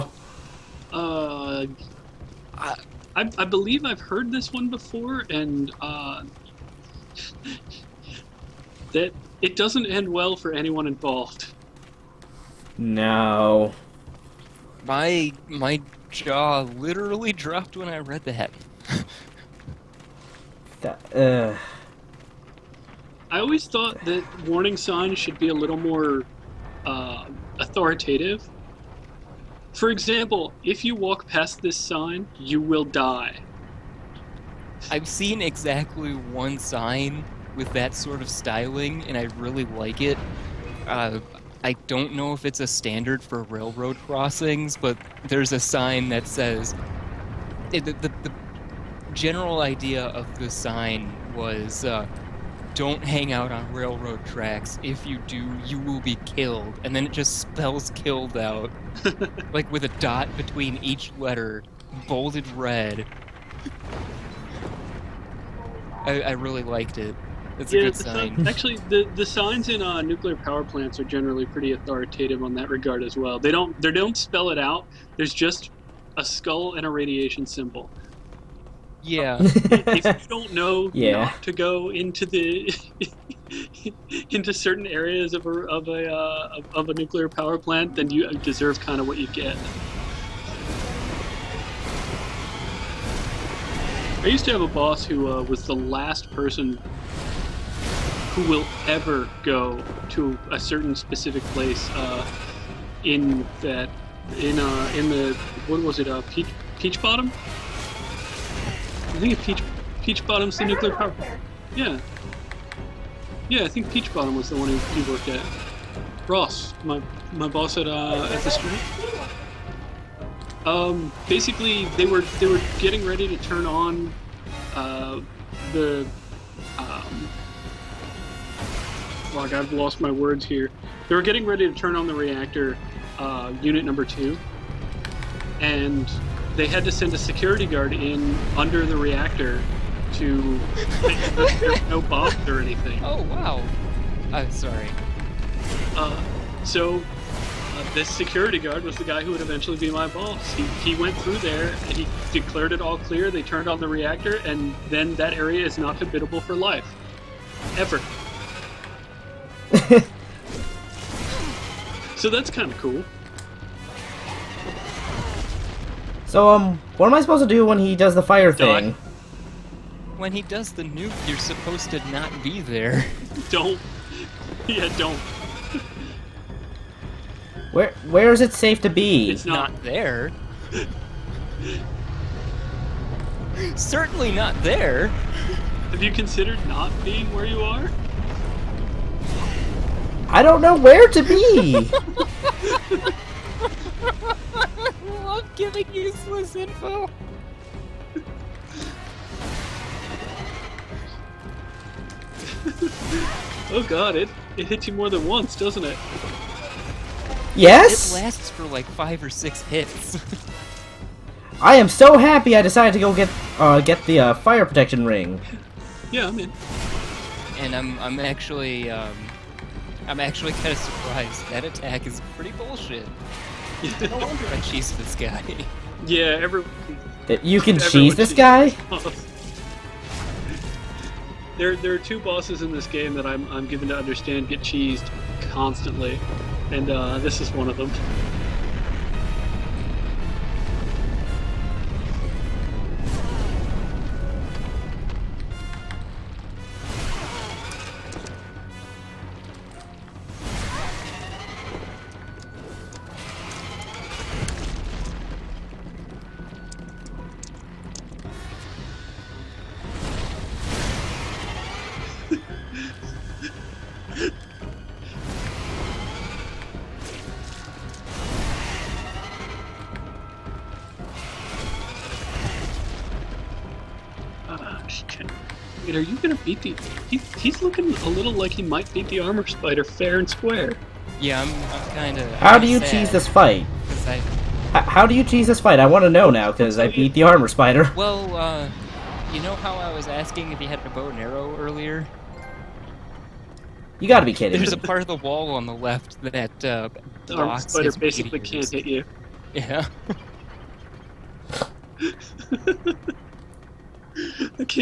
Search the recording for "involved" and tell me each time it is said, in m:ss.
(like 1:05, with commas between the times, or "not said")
0:10.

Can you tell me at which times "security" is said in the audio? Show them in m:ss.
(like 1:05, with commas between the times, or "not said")
2:17, 2:28.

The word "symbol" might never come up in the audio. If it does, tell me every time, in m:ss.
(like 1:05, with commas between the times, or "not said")
1:17.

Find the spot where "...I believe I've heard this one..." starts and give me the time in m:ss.
0:03.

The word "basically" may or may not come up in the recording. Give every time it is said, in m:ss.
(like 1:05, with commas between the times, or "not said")
2:01, 4:57.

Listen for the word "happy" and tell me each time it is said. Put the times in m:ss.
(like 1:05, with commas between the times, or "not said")
3:32.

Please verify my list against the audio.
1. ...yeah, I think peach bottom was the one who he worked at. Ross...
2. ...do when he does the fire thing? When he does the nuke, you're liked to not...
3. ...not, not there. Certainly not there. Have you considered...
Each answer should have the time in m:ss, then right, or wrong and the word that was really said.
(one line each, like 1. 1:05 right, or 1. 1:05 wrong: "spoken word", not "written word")
1. 1:53 right
2. 2:47 wrong: "supposed", not "liked"
3. 2:59 right.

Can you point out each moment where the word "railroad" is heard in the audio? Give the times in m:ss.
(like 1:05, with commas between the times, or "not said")
0:43, 0:53.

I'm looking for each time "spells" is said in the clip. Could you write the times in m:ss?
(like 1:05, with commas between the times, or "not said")
0:57, 1:14.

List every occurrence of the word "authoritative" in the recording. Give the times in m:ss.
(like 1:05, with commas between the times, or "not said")
0:27, 1:11.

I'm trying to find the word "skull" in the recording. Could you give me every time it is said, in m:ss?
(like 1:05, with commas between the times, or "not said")
1:16.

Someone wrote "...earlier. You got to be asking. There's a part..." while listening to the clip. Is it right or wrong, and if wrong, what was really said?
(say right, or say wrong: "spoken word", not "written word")
wrong: "kidding", not "asking".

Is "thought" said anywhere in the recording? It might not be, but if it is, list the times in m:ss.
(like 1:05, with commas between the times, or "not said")
0:23.